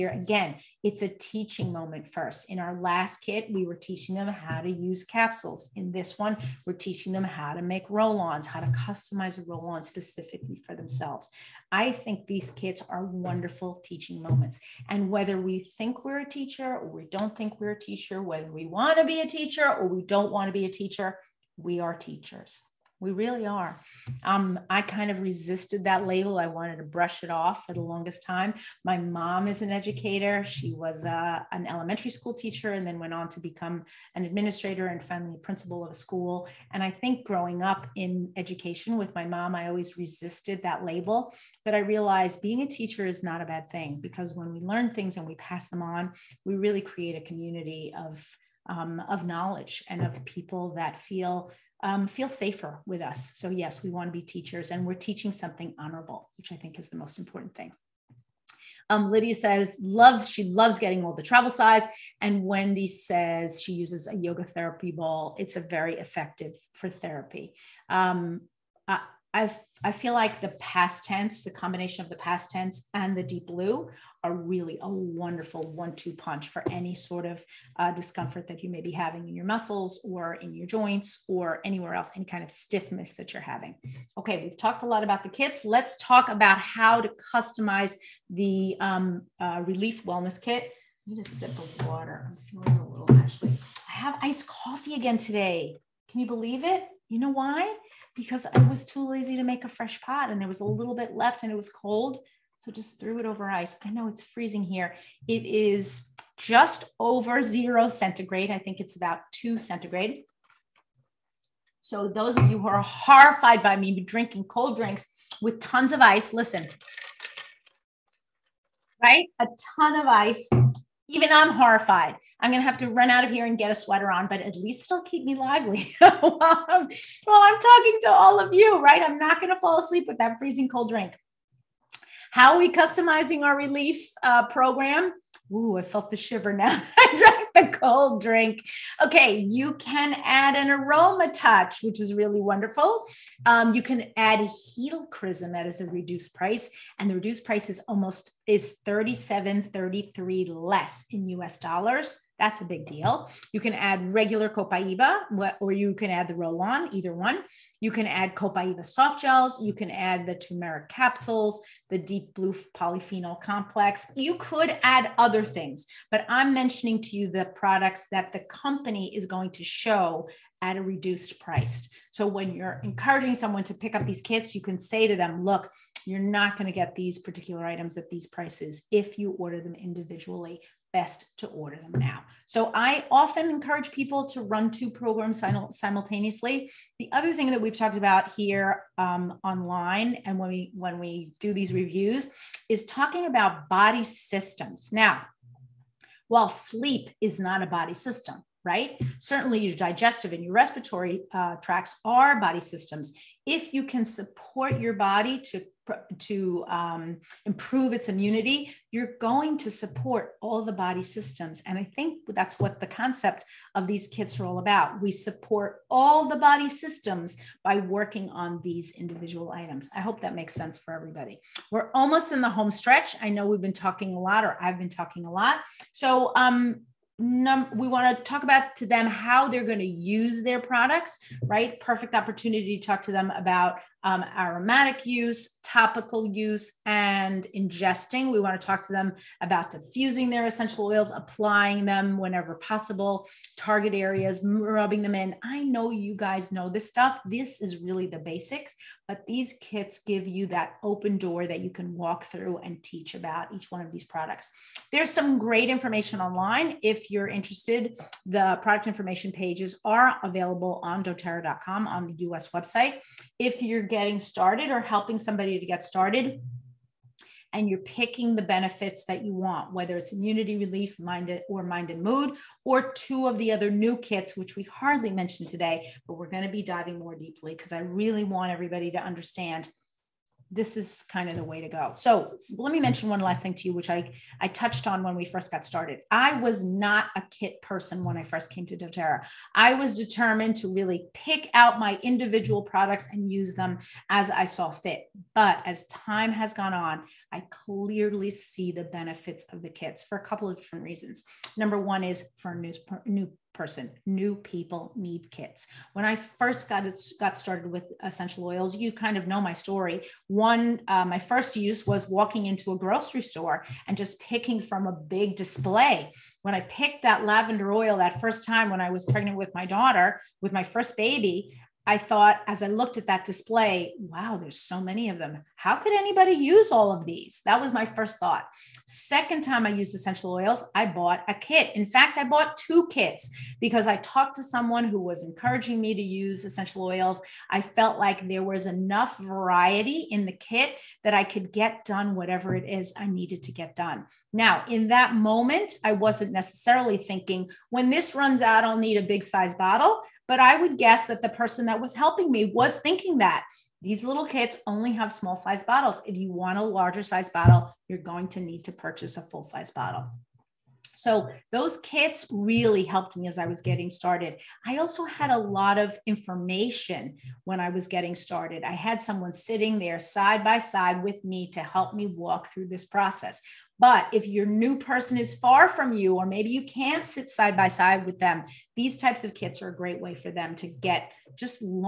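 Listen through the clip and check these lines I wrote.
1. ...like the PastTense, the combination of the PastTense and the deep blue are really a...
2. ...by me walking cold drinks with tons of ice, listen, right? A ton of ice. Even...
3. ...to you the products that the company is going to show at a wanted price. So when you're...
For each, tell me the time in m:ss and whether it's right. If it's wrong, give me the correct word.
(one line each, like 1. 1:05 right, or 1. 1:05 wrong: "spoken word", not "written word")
1. 1:10 right
2. 1:53 wrong: "drinking", not "walking"
3. 2:47 wrong: "reduced", not "wanted".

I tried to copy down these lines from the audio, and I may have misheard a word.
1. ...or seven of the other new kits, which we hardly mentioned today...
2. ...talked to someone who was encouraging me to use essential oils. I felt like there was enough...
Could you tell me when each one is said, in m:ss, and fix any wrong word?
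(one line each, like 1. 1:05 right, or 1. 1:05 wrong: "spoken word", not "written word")
1. 4:32 wrong: "two", not "seven"
2. 5:33 right.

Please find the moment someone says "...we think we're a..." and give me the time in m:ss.
0:15.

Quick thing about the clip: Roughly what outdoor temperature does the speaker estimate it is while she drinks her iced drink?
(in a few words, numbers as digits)
2 centigrade.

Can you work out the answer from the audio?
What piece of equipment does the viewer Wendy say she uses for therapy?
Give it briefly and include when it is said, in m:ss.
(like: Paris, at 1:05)
yoga therapy ball, at 1:04.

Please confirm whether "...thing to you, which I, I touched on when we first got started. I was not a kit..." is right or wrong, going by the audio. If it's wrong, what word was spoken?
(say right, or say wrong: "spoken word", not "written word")
right.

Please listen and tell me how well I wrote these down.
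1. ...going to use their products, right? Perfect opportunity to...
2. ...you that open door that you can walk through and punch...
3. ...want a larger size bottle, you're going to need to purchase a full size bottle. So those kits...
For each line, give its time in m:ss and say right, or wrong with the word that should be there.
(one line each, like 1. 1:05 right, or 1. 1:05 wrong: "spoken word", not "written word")
1. 3:49 right
2. 4:10 wrong: "teach", not "punch"
3. 5:56 right.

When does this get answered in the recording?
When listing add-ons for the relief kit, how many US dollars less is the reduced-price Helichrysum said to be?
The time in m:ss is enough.
2:28.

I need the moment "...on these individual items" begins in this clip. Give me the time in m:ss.
3:38.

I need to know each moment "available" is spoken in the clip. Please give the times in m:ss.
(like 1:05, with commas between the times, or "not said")
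4:20.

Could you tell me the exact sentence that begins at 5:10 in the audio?
One, uh, my first use was walking into a grocery store and just picking from a big display.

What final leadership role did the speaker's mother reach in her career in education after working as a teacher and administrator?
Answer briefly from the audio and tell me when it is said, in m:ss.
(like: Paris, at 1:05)
principal, at 0:35.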